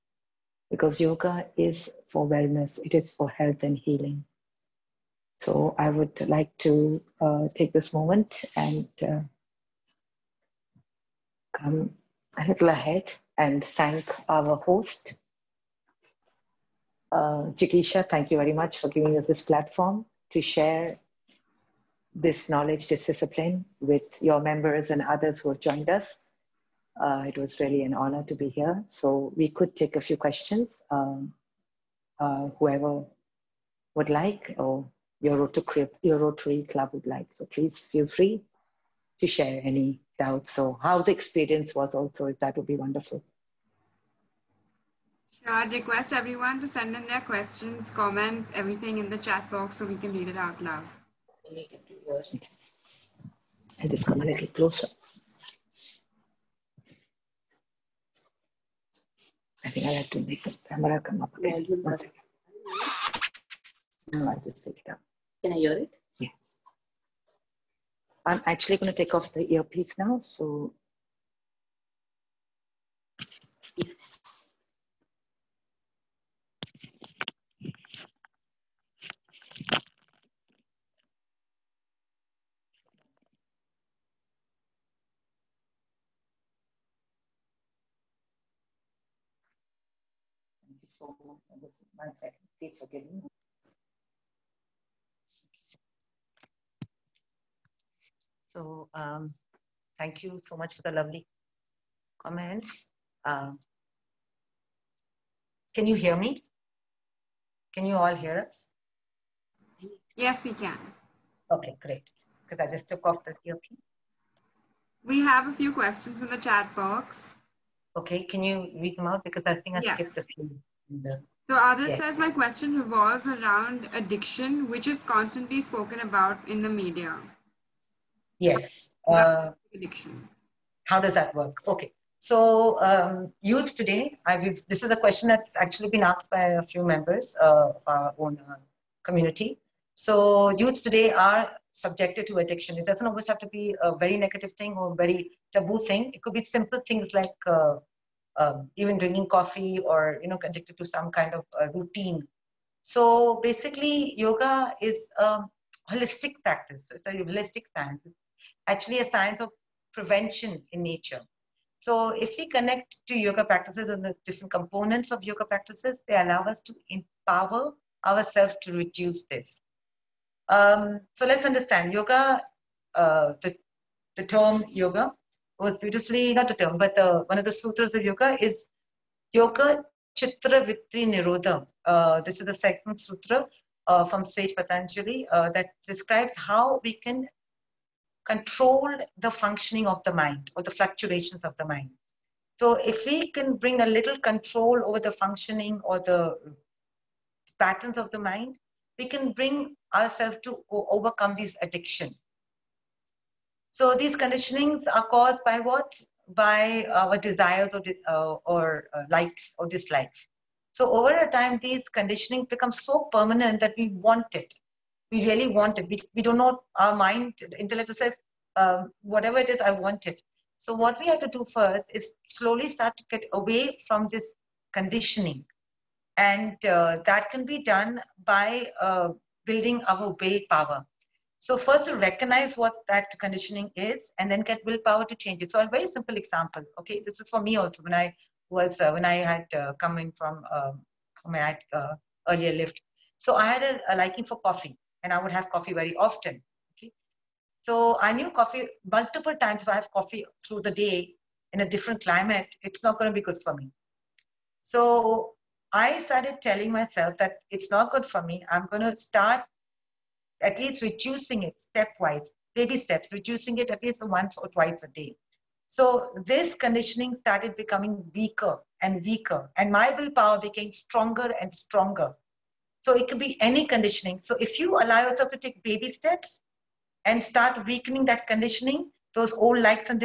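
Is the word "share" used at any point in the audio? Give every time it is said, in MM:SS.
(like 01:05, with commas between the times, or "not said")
00:20, 00:39.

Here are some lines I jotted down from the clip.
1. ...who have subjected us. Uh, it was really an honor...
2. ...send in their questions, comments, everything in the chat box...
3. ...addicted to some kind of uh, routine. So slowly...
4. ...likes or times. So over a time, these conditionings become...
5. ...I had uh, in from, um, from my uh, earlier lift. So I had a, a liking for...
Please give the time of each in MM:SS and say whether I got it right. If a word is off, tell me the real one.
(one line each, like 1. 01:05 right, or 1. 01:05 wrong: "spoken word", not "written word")
1. 00:25 wrong: "joined", not "subjected"
2. 00:46 right
3. 02:30 wrong: "basically", not "slowly"
4. 03:29 wrong: "dislikes", not "times"
5. 03:59 right.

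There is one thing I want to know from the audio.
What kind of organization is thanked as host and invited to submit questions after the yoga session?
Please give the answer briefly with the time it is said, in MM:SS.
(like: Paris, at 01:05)
Rotary Club, at 00:36.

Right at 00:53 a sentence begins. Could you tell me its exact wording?
I'll just come a little closer.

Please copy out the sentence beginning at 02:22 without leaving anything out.
It doesn't always have to be a very negative thing or a very taboo thing.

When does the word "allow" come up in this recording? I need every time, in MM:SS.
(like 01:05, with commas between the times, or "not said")
02:46, 04:34.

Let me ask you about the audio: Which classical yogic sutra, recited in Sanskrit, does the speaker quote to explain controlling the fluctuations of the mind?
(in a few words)
Yoga Chitta Vritti Nirodha.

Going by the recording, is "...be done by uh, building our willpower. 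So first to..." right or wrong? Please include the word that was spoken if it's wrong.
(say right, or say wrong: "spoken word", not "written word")
right.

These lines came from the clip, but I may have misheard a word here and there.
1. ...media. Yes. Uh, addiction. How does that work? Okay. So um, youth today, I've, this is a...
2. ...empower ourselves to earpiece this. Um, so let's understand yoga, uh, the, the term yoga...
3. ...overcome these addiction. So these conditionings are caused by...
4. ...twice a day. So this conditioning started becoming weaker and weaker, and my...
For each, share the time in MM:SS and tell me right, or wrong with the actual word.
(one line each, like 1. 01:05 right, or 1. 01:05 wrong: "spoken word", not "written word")
1. 02:06 right
2. 02:46 wrong: "reduce", not "earpiece"
3. 03:20 right
4. 04:24 right.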